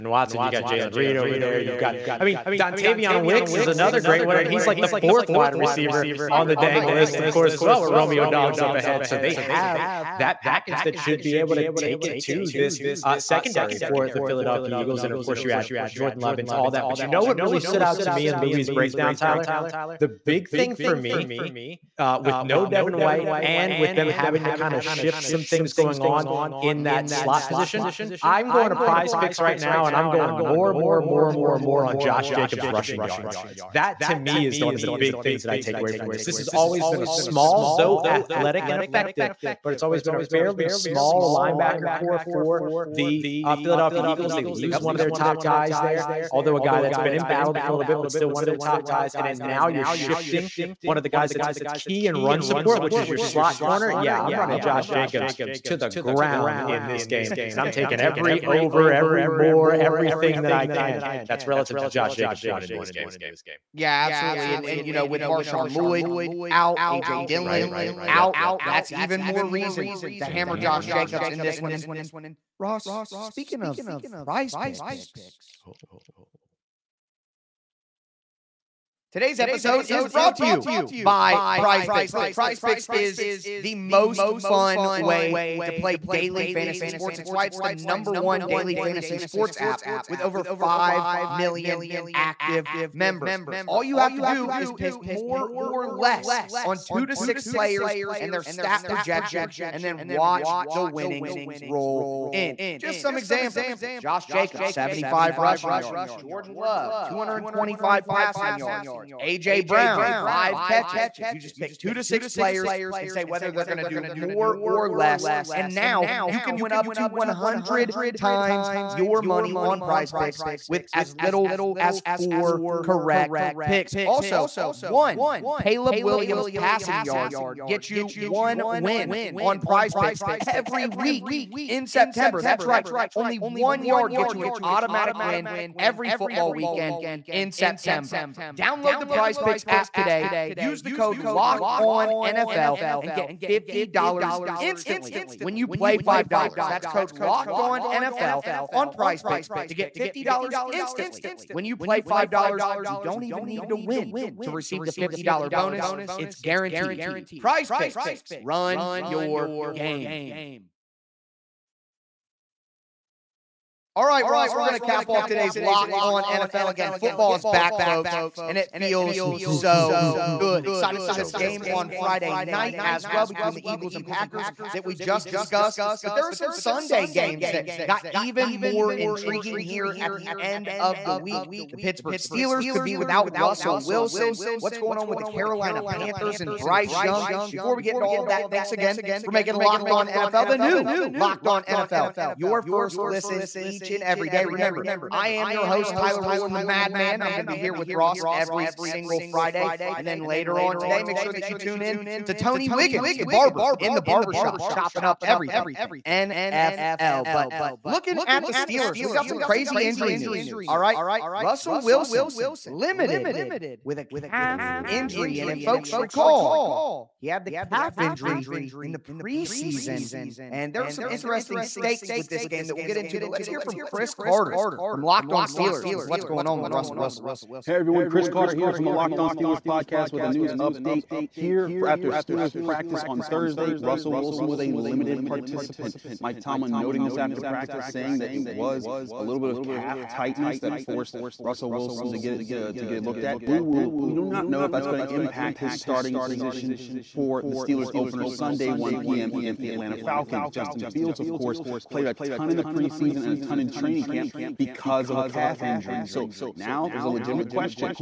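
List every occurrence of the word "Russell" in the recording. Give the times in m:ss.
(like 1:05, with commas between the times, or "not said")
3:03, 3:31, 3:46, 3:53, 4:01.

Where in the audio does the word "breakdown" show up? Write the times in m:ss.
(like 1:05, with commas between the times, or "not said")
0:18.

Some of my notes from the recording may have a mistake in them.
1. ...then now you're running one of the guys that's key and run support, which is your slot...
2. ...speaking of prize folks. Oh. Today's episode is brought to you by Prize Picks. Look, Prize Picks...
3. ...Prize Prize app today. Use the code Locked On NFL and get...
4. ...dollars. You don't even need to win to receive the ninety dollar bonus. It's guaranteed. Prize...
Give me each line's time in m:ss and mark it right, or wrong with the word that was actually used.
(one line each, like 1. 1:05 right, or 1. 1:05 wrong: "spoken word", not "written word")
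1. 0:49 wrong: "shifting", not "running"
2. 1:13 wrong: "picks", not "folks"
3. 2:19 wrong: "Picks", not "Prize"
4. 2:32 wrong: "fifty", not "ninety".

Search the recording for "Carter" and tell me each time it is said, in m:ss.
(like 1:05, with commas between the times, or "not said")
3:44, 3:48.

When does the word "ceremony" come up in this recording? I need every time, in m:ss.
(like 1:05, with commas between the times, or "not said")
not said.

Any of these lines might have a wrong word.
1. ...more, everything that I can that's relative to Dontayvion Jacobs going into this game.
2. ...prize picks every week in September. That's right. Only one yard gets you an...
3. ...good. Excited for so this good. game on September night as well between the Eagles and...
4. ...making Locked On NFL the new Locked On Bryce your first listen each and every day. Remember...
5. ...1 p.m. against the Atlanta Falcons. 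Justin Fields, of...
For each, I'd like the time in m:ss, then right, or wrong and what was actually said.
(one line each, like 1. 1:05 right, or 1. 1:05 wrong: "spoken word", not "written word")
1. 0:59 wrong: "Josh", not "Dontayvion"
2. 2:09 right
3. 2:50 wrong: "Friday", not "September"
4. 3:09 wrong: "NFL", not "Bryce"
5. 4:08 right.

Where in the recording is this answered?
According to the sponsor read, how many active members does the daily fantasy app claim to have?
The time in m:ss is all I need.
1:30.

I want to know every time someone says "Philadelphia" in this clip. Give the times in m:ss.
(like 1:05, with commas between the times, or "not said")
0:14, 0:43.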